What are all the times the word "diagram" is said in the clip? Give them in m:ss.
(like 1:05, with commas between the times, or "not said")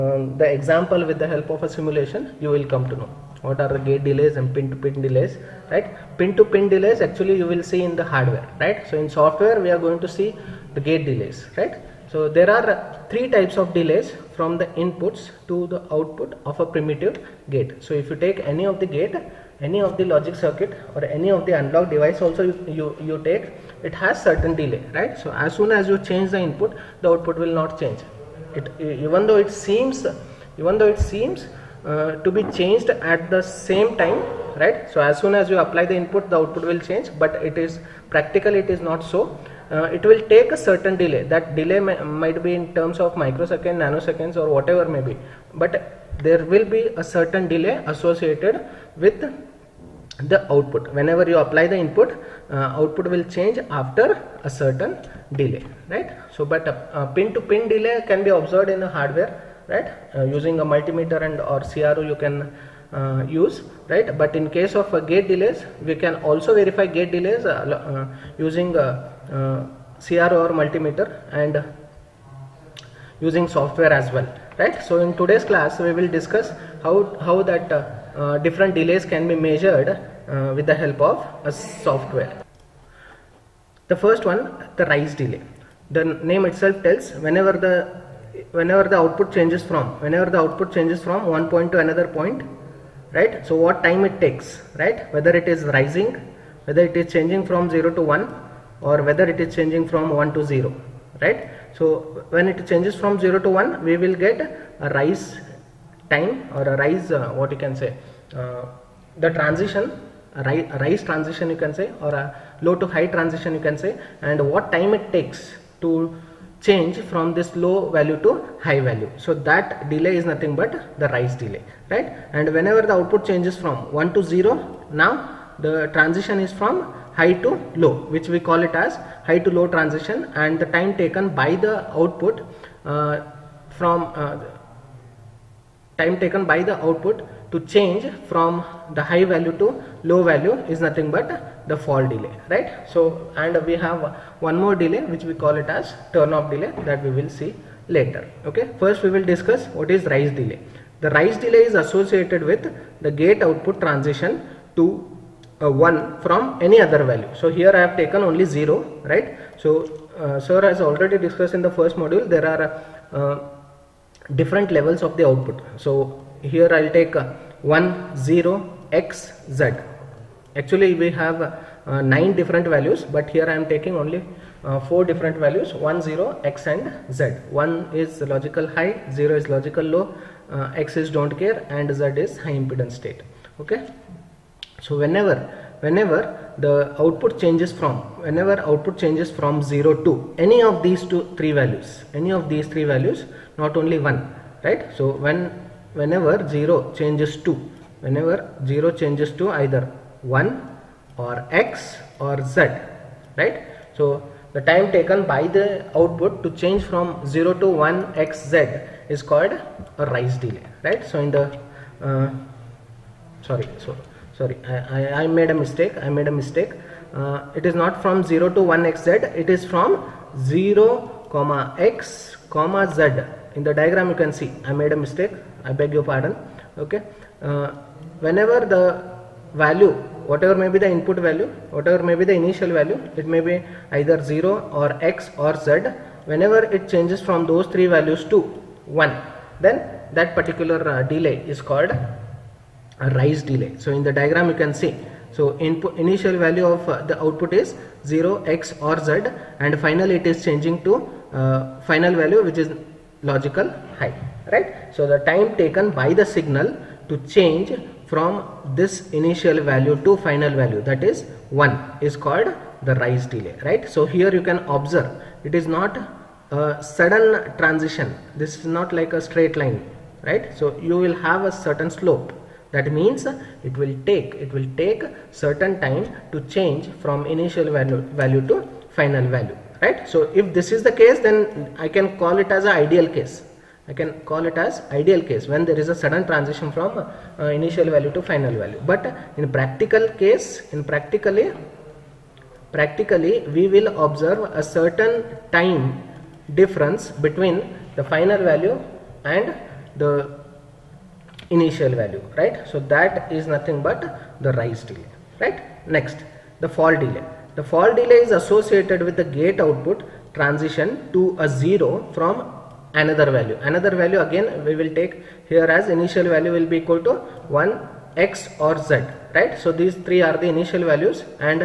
3:43, 4:04.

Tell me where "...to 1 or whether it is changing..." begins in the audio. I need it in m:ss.
1:37.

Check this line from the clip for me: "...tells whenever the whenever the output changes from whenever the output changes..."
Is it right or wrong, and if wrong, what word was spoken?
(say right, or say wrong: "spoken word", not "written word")
right.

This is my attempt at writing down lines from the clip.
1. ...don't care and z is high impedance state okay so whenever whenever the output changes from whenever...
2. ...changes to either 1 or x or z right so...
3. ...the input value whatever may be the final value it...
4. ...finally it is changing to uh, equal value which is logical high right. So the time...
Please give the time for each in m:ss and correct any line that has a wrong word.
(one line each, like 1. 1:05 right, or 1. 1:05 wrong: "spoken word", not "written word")
1. 3:01 right
2. 3:19 right
3. 3:50 wrong: "initial", not "final"
4. 4:09 wrong: "final", not "equal".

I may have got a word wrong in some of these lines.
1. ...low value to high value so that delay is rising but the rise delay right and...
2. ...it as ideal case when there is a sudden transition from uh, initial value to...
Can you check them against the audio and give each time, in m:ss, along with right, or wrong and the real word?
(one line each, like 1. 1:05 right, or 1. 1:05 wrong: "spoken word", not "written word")
1. 1:57 wrong: "nothing", not "rising"
2. 4:44 right.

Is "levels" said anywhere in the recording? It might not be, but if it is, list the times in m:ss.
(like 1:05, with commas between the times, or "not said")
2:44.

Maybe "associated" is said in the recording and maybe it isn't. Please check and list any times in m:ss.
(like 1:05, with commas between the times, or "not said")
0:47, 2:31, 5:08.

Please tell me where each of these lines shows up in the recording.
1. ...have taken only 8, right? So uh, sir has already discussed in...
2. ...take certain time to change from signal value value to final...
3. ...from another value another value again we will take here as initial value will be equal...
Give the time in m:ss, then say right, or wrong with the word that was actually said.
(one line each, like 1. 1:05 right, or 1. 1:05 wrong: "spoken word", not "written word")
1. 2:37 wrong: "0", not "8"
2. 4:34 wrong: "initial", not "signal"
3. 5:12 right.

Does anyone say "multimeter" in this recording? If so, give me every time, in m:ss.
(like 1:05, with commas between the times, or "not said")
1:00, 1:10.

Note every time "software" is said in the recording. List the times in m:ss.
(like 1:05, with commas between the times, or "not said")
0:09, 1:13, 1:21.